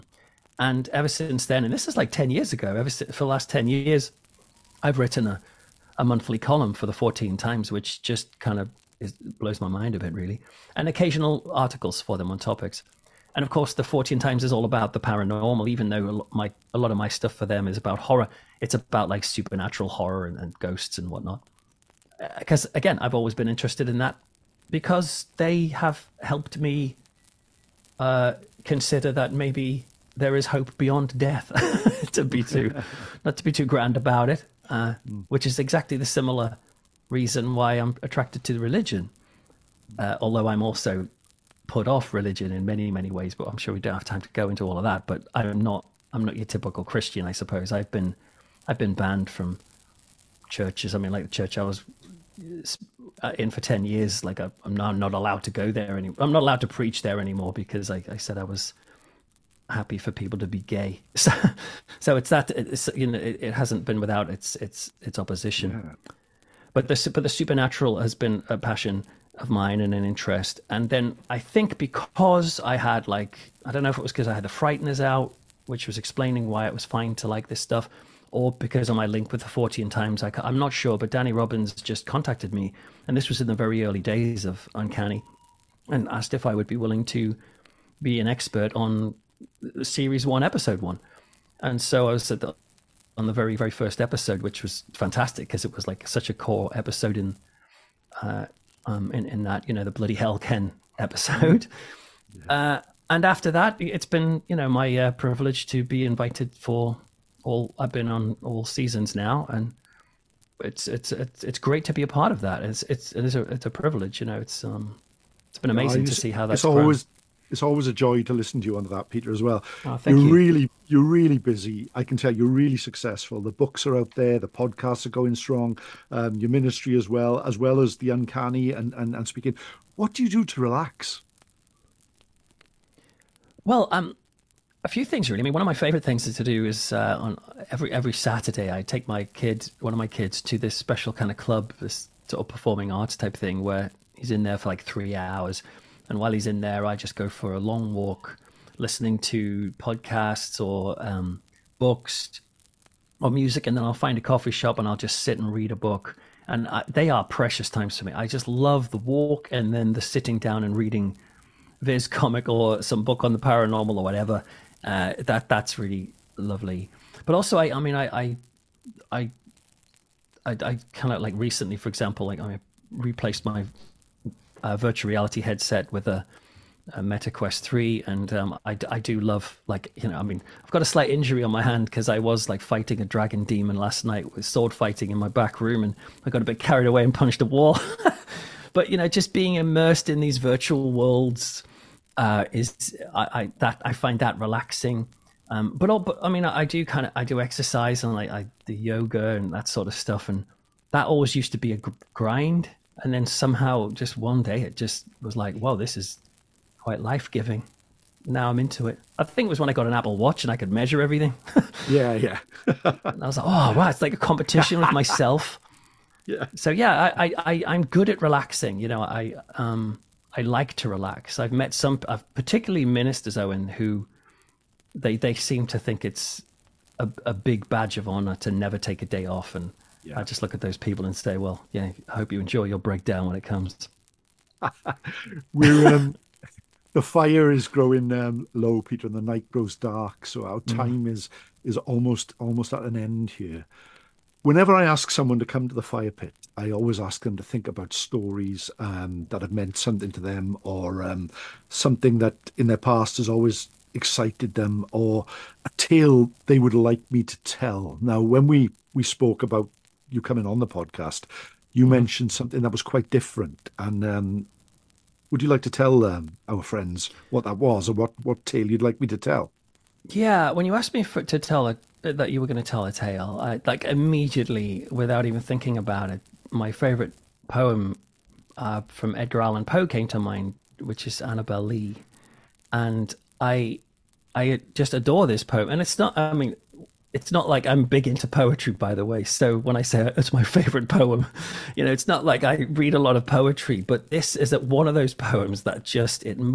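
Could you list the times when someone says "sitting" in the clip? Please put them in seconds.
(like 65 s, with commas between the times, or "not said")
160 s.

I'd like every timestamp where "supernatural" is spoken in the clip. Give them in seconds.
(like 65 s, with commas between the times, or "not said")
19 s, 67 s.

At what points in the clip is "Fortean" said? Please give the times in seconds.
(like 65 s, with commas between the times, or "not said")
6 s, 13 s, 79 s.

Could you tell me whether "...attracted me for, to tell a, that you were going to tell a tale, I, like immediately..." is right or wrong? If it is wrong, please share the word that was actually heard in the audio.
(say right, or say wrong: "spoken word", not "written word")
wrong: "asked", not "attracted".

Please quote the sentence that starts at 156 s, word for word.
And I, they are precious times for me.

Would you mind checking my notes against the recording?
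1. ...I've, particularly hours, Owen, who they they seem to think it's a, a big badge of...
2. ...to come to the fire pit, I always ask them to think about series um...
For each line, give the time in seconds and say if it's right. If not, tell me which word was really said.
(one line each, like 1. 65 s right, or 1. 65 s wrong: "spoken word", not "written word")
1. 222 s wrong: "ministers", not "hours"
2. 245 s wrong: "stories", not "series".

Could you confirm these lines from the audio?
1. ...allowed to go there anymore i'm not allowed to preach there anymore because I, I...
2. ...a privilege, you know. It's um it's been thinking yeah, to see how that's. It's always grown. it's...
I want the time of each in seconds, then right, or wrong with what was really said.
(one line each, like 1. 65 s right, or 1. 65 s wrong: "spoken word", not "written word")
1. 55 s right
2. 113 s wrong: "amazing", not "thinking".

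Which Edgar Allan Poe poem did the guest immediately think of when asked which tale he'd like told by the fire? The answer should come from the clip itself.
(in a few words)
Annabel Lee.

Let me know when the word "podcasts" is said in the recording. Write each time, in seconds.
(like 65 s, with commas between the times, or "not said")
124 s, 149 s, 260 s.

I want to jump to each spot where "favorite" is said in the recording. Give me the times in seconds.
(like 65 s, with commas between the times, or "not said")
135 s, 276 s, 290 s.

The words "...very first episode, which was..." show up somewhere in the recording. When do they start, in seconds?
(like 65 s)
93 s.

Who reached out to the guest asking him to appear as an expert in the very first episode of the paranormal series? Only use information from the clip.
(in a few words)
Danny Robins.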